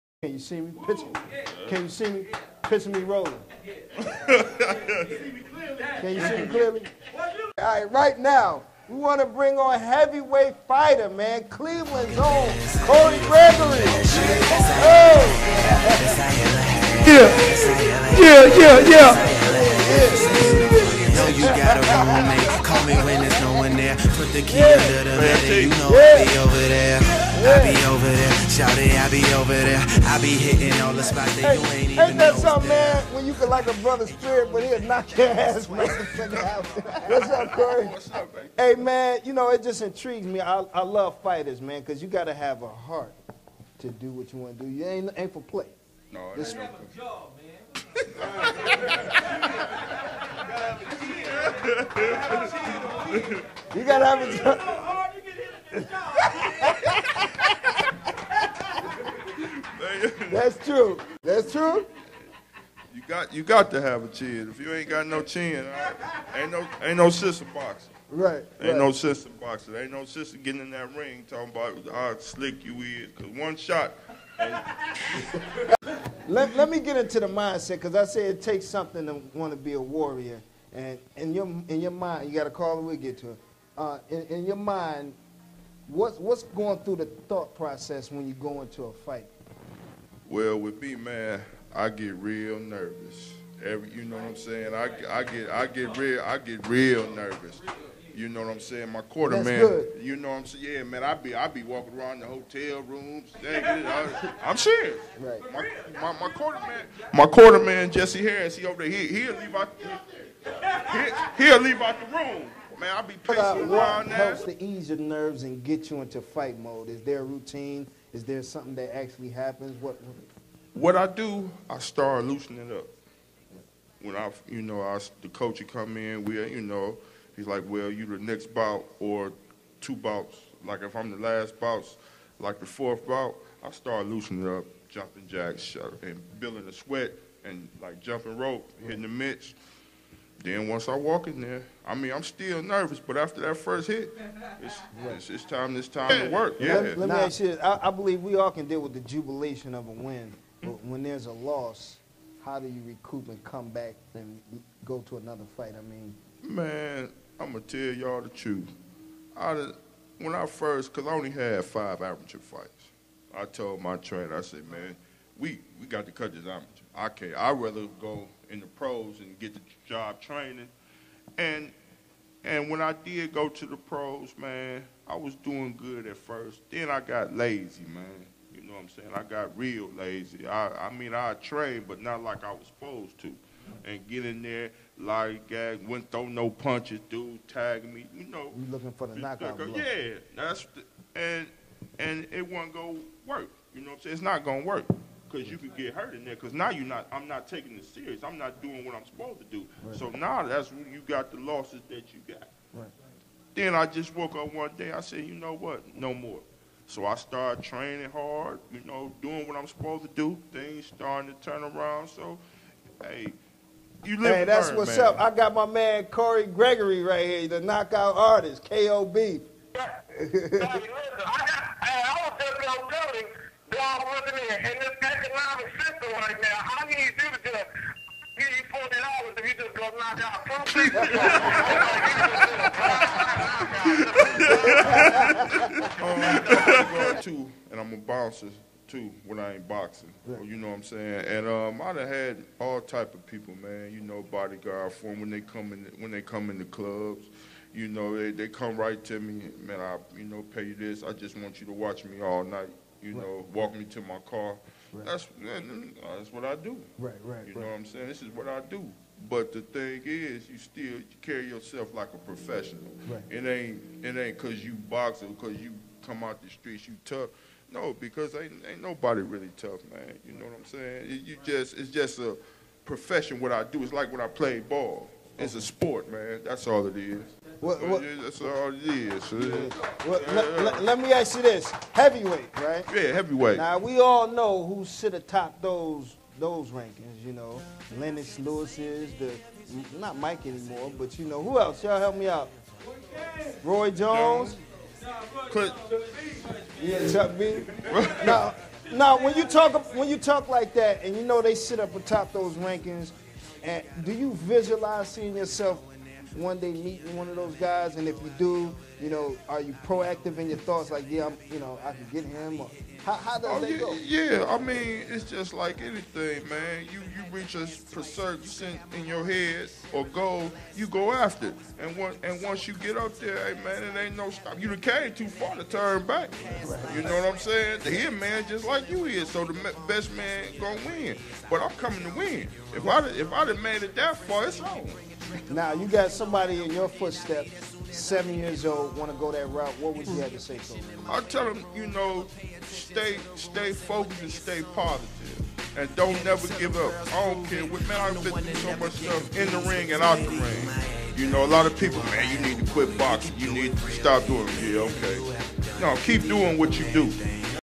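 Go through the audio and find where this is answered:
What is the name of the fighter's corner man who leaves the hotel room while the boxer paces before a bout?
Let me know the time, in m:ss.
1:47.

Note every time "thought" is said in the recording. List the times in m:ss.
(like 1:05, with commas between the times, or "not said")
1:27, 5:10.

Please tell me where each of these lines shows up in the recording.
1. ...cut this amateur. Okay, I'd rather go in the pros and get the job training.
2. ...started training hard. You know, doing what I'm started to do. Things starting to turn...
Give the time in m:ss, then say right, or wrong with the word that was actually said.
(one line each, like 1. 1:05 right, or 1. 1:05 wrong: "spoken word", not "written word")
1. 2:46 right
2. 3:27 wrong: "supposed", not "started".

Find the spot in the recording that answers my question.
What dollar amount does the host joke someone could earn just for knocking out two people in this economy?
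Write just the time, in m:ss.
3:48.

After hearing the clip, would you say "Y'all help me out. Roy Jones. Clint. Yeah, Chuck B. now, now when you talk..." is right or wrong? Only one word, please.
right.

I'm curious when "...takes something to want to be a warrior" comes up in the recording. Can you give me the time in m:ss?
1:18.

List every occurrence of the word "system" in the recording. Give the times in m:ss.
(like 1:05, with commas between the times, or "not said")
3:45.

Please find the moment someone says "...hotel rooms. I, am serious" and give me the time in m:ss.
1:42.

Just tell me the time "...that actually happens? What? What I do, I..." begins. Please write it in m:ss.
1:58.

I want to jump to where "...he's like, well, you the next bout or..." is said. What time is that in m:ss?
2:07.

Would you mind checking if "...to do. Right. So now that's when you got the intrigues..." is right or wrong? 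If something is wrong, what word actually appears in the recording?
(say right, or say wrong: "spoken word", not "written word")
wrong: "losses", not "intrigues".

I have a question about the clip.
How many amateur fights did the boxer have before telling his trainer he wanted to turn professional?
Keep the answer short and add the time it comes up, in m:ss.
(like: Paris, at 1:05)
5, at 2:41.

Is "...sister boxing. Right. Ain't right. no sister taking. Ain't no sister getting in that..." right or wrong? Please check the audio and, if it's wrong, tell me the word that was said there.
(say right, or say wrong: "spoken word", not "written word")
wrong: "boxing", not "taking".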